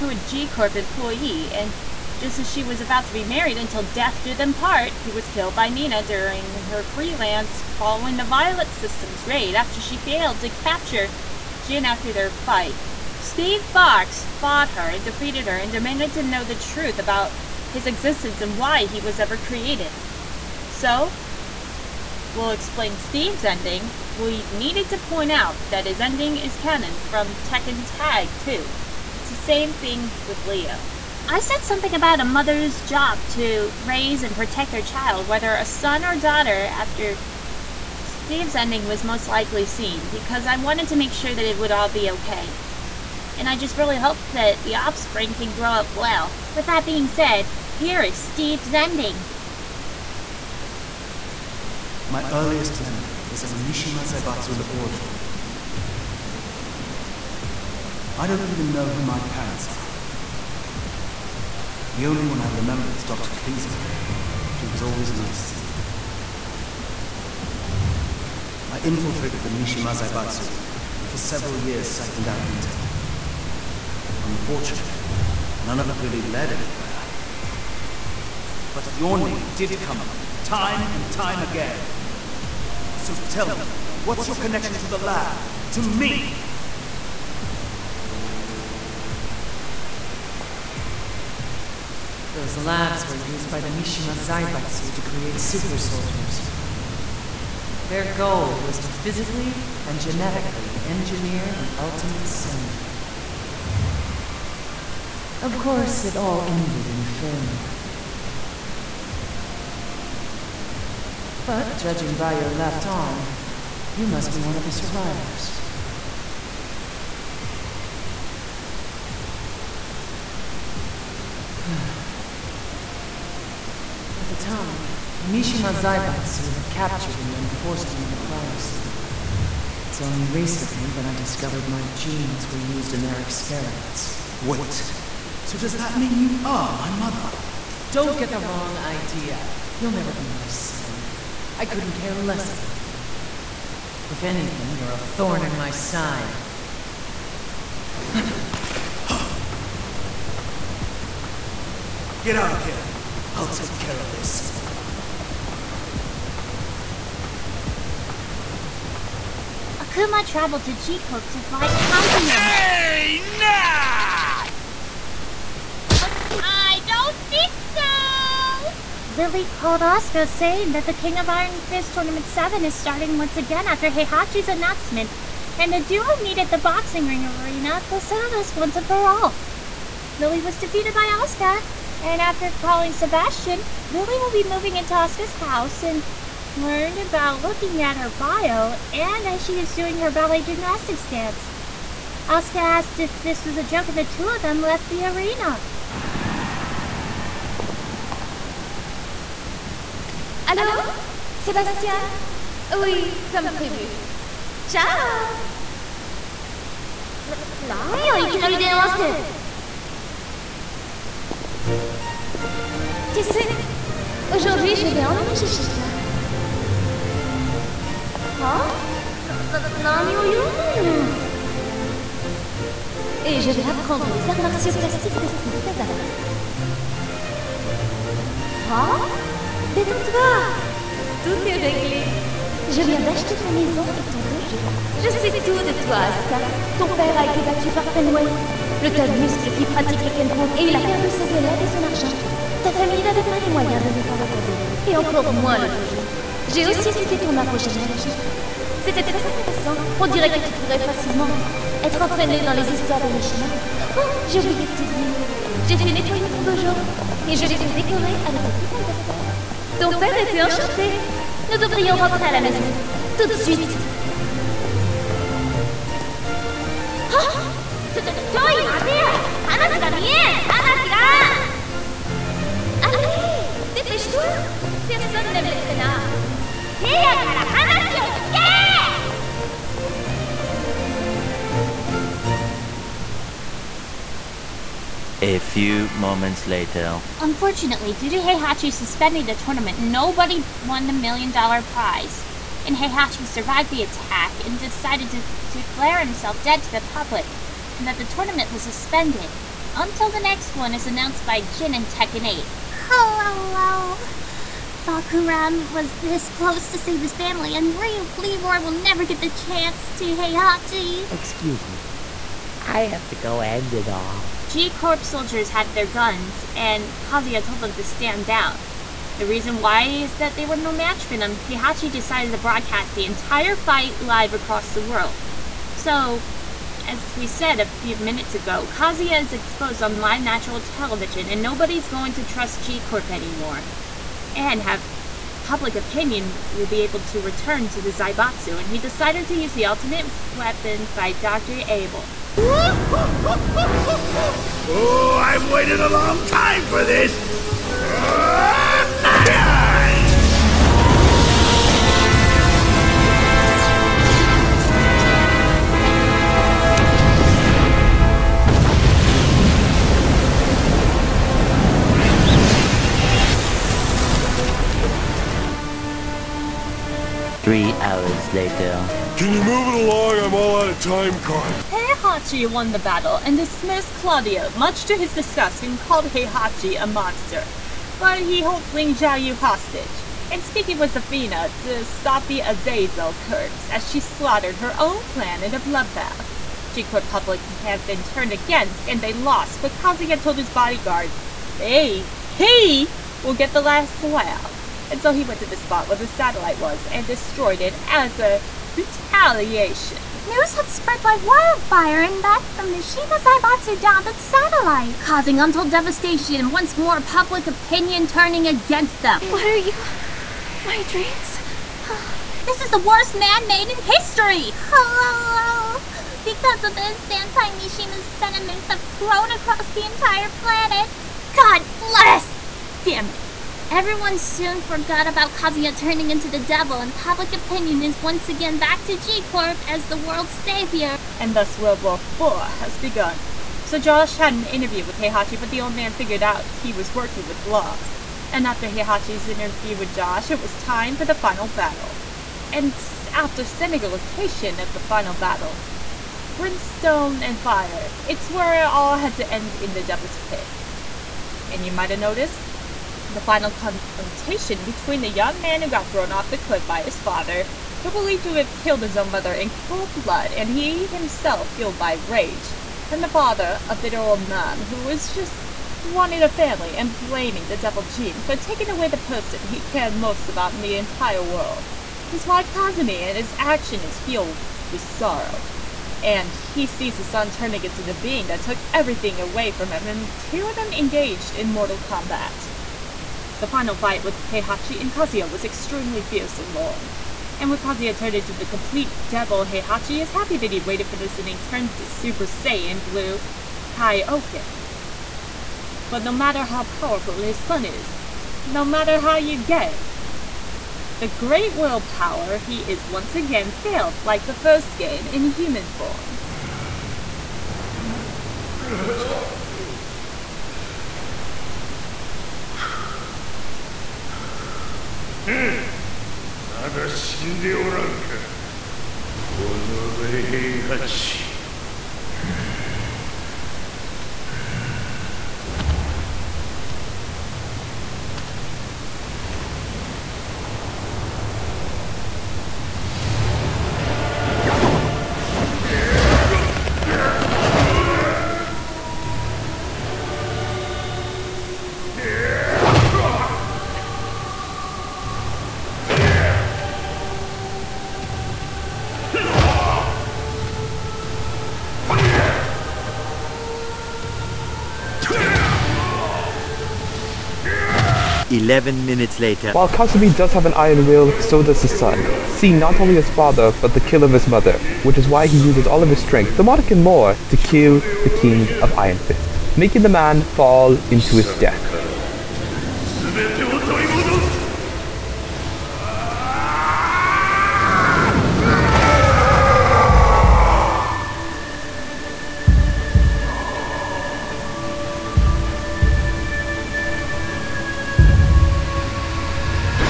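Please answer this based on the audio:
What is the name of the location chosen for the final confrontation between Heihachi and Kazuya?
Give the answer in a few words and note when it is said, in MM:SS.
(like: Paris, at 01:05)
Devil's Pit, at 07:29.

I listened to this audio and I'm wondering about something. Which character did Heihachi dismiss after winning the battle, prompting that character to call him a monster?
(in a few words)
Claudio.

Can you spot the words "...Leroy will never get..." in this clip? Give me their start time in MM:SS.
05:08.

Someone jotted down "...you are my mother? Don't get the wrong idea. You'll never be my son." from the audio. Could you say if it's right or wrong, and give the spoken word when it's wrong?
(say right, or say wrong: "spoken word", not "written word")
right.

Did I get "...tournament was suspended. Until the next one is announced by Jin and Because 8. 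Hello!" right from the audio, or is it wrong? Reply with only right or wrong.
wrong.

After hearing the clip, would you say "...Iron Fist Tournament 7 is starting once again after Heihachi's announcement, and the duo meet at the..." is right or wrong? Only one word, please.
right.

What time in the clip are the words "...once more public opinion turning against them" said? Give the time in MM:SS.
06:46.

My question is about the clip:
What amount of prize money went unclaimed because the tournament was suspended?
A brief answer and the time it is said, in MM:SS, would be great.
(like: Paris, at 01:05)
Million dollar, at 04:50.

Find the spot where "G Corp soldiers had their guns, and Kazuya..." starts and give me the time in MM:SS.
05:14.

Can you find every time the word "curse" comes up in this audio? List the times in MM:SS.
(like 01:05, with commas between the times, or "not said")
06:23.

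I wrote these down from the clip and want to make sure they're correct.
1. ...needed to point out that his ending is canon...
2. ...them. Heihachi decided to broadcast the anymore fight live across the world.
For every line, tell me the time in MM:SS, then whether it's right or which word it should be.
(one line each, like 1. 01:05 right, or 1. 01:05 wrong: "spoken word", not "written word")
1. 00:24 right
2. 05:21 wrong: "entire", not "anymore".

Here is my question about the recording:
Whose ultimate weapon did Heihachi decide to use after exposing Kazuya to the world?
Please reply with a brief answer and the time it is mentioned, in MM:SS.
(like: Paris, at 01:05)
Dr. Abel, at 05:41.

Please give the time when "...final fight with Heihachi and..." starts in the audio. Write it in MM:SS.
08:03.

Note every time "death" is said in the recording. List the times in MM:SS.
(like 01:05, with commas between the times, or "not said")
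00:03, 09:31.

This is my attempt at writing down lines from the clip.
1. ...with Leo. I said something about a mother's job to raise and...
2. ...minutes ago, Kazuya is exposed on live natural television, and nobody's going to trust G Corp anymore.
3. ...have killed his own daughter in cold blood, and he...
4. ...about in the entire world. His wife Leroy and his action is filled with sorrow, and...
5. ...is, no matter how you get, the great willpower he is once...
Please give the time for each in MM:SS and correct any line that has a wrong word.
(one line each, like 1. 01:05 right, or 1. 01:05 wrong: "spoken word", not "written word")
1. 00:30 right
2. 05:27 right
3. 07:38 wrong: "mother", not "daughter"
4. 07:50 wrong: "Kazumi", not "Leroy"
5. 08:17 right.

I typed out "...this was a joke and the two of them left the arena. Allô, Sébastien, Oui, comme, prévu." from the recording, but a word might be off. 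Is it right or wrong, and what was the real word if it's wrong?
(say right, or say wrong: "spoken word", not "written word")
right.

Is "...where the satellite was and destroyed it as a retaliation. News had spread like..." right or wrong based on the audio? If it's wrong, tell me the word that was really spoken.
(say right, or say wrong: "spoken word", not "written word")
right.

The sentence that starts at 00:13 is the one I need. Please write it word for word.
Steve Fox fought her and defeated her and demanded to know the truth about his existence and why he was ever created.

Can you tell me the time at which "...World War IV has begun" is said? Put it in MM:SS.
07:11.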